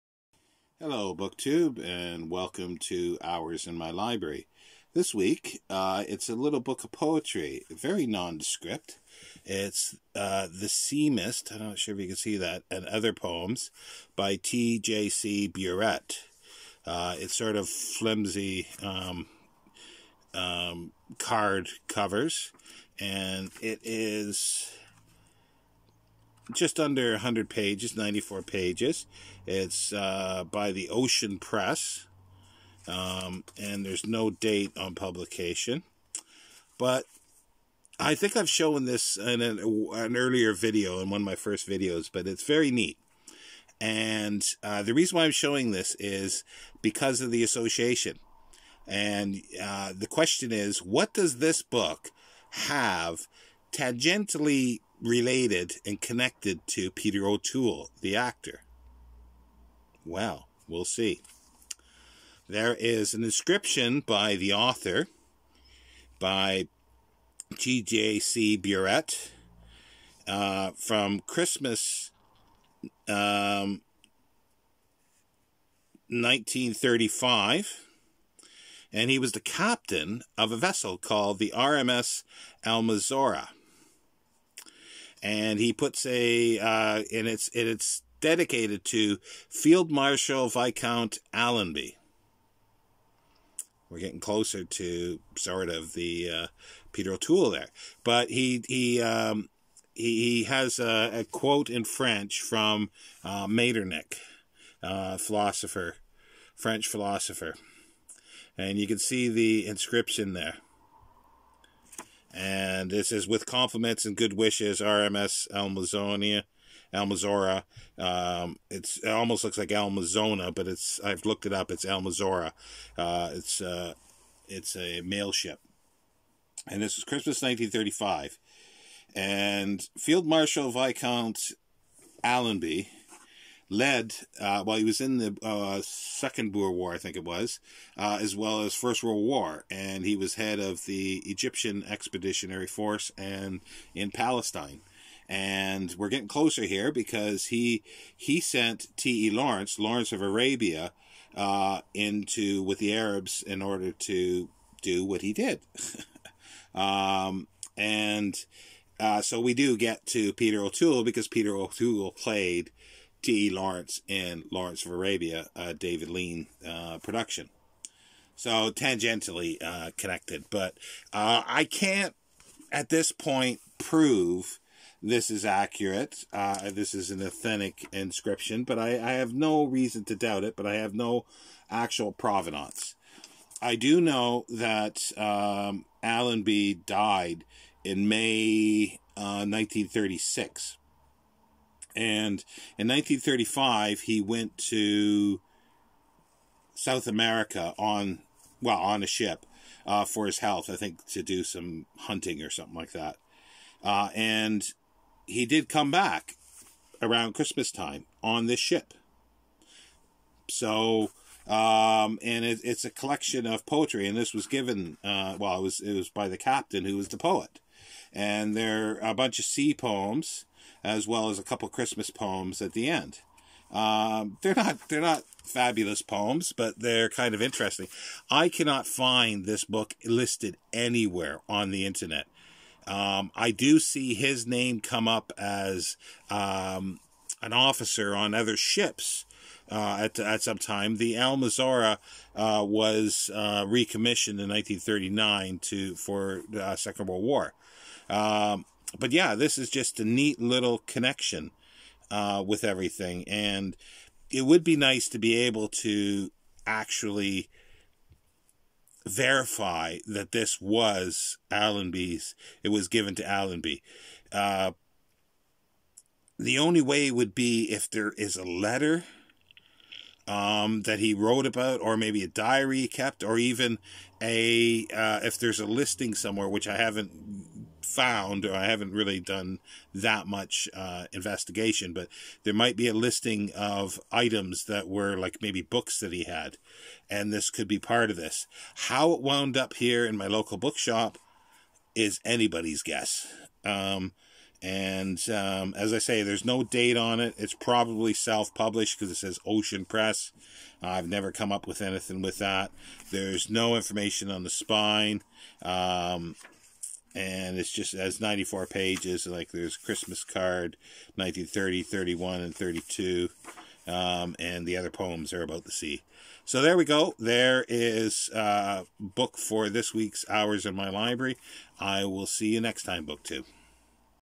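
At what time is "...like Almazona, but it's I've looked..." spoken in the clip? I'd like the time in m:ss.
1:59.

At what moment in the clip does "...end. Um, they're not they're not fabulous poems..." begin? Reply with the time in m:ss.
3:42.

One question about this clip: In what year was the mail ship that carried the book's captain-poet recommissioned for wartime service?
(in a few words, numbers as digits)
1939.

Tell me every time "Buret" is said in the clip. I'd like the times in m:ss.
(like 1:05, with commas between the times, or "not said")
0:15, 1:08.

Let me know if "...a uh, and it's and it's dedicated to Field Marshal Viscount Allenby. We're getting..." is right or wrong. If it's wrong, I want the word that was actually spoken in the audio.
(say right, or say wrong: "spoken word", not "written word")
right.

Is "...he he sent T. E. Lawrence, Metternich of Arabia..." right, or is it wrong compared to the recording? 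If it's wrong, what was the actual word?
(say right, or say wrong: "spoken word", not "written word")
wrong: "Lawrence", not "Metternich".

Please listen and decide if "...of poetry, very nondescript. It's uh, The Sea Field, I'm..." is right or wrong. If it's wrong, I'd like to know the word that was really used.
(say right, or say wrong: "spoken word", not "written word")
wrong: "Mist", not "Field".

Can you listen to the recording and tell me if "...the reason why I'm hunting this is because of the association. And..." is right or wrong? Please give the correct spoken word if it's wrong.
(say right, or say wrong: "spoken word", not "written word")
wrong: "showing", not "hunting".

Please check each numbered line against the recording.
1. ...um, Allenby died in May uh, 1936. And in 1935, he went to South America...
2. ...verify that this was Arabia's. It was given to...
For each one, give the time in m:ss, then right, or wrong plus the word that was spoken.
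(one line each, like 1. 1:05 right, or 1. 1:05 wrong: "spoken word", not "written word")
1. 3:05 right
2. 4:19 wrong: "Allenby", not "Arabia".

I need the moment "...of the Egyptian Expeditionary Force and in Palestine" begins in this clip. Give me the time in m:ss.
2:20.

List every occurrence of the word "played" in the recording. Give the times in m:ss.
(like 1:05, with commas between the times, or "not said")
2:42.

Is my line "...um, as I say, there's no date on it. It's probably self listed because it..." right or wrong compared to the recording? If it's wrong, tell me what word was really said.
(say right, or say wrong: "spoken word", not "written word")
wrong: "published", not "listed".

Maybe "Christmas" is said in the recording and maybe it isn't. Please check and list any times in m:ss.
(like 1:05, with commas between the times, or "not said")
1:11, 2:07, 3:27, 3:41, 5:09.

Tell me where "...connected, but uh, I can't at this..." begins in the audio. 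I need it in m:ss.
2:49.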